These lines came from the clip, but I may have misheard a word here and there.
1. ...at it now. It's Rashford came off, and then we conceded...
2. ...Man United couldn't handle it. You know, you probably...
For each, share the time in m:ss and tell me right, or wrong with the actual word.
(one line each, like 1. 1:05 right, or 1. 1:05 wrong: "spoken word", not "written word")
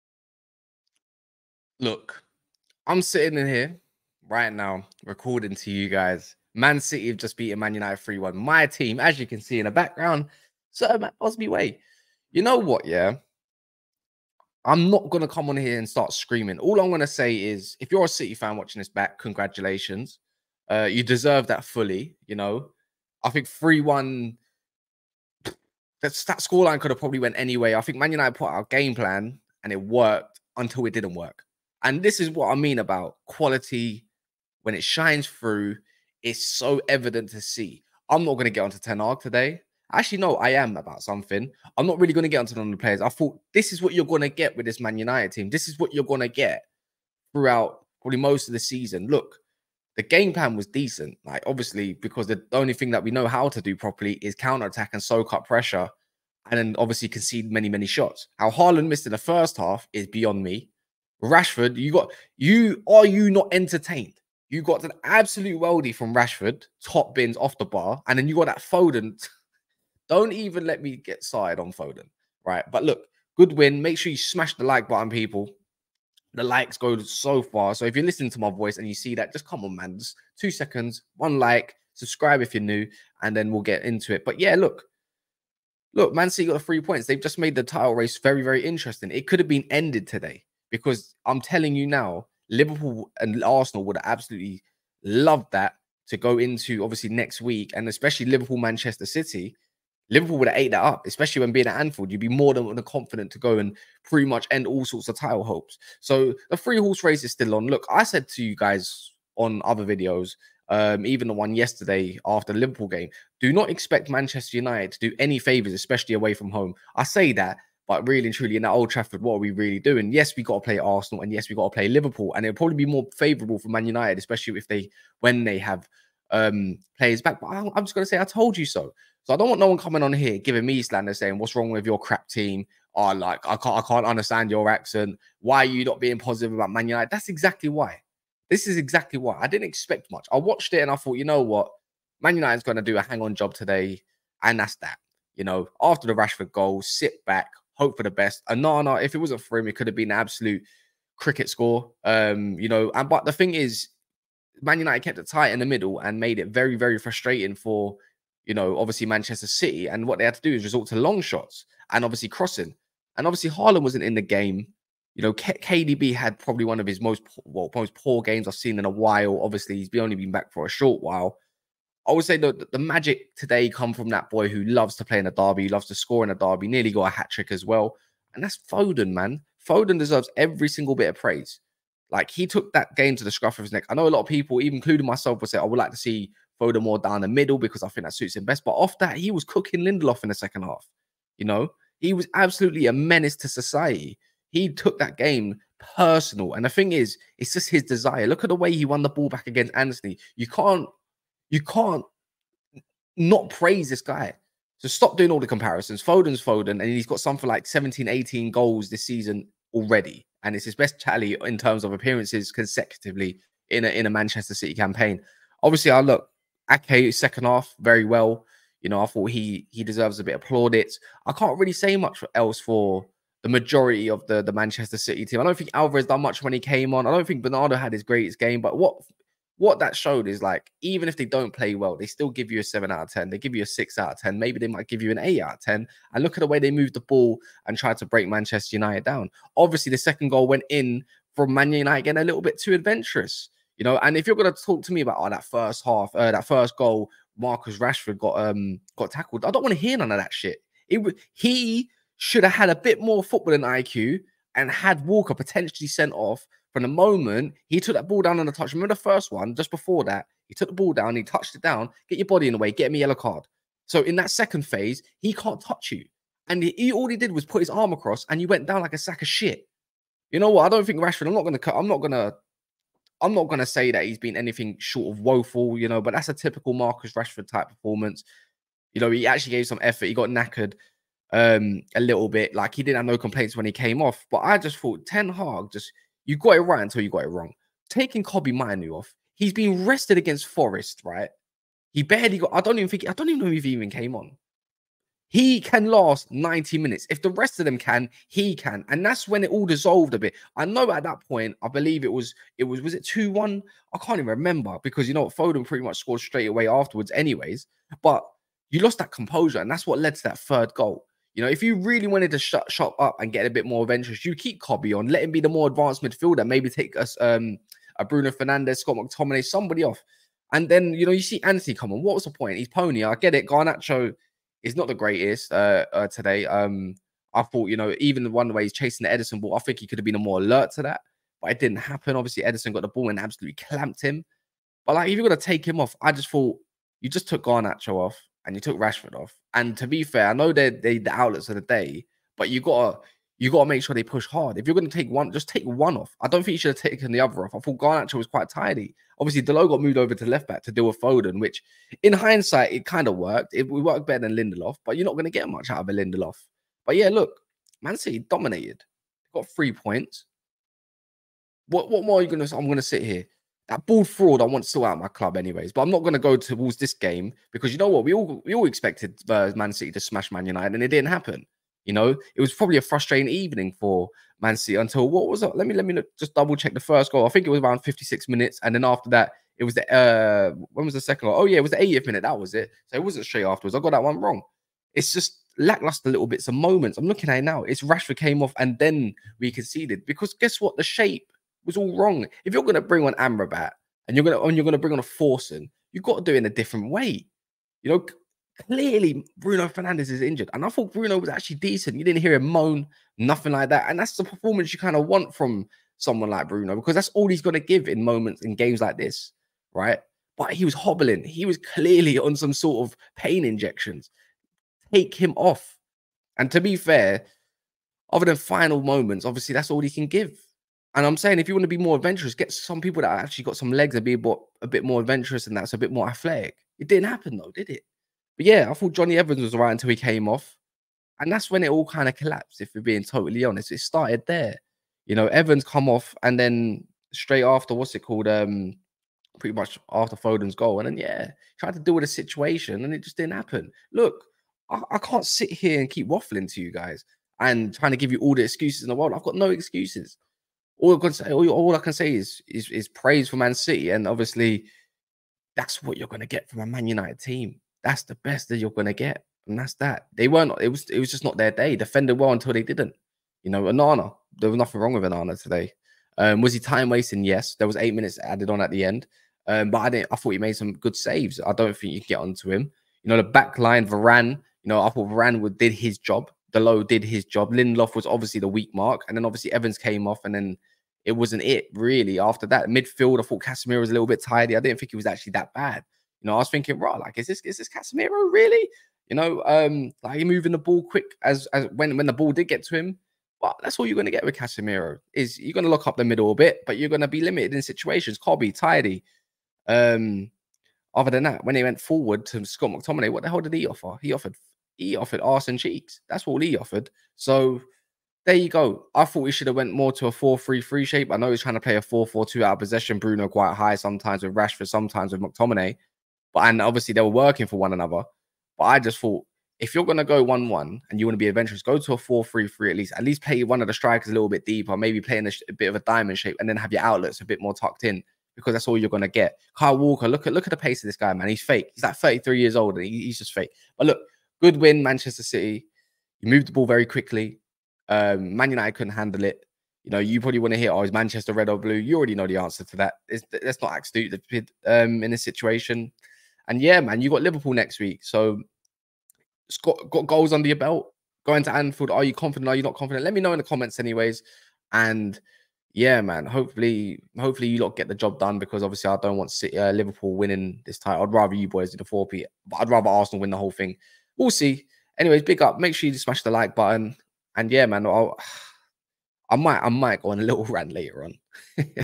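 1. 6:27 right
2. 8:58 right.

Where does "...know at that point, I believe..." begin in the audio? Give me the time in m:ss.
5:00.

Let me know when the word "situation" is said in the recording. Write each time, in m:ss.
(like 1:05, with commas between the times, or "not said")
7:22, 8:17, 9:05.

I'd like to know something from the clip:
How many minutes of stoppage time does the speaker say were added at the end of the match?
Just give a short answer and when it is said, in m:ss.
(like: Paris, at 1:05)
8, at 7:47.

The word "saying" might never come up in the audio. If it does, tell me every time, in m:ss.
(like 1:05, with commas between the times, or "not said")
2:11, 7:01.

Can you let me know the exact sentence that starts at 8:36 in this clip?
But and obviously they were working for one another.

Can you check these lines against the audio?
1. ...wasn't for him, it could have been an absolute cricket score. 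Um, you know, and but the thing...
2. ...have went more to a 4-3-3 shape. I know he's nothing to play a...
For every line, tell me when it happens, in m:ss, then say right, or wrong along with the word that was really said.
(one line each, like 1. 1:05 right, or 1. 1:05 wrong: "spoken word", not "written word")
1. 2:29 right
2. 8:29 wrong: "trying", not "nothing".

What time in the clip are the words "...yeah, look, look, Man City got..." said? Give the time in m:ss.
1:24.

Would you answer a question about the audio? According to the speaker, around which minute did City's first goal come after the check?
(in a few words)
56.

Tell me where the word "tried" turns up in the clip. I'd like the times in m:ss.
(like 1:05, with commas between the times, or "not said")
3:57, 7:21.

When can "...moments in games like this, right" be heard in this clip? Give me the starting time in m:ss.
6:48.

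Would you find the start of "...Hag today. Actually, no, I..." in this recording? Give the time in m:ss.
0:38.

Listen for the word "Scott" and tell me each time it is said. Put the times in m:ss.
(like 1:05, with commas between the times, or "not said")
5:18, 8:22.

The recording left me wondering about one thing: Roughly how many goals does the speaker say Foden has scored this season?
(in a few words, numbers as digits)
17, 18.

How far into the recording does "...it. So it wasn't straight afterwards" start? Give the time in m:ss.
6:22.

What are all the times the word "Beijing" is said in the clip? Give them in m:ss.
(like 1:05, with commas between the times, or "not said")
not said.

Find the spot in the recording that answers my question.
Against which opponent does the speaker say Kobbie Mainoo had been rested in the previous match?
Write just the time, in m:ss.
4:50.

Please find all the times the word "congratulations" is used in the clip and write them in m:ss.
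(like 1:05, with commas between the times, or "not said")
0:19.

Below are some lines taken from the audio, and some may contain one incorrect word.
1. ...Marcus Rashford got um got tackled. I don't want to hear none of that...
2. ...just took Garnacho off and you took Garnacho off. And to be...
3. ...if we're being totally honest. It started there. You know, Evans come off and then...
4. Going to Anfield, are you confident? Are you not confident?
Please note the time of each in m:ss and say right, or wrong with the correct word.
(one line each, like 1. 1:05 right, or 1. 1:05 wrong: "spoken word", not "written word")
1. 4:07 right
2. 5:37 wrong: "Rashford", not "Garnacho"
3. 7:12 right
4. 9:11 right.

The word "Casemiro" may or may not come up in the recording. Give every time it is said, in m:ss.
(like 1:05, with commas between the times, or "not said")
8:03, 8:07, 8:14.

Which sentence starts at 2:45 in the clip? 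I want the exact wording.
You know, K KDB had probably one of his most well, most poor games I've seen in a while.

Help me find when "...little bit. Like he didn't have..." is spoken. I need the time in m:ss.
4:41.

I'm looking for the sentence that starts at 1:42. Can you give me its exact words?
You'd be more than confident to go and pretty much end all sorts of title hopes.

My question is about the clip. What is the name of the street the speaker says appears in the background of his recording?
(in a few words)
Sir Busby Way.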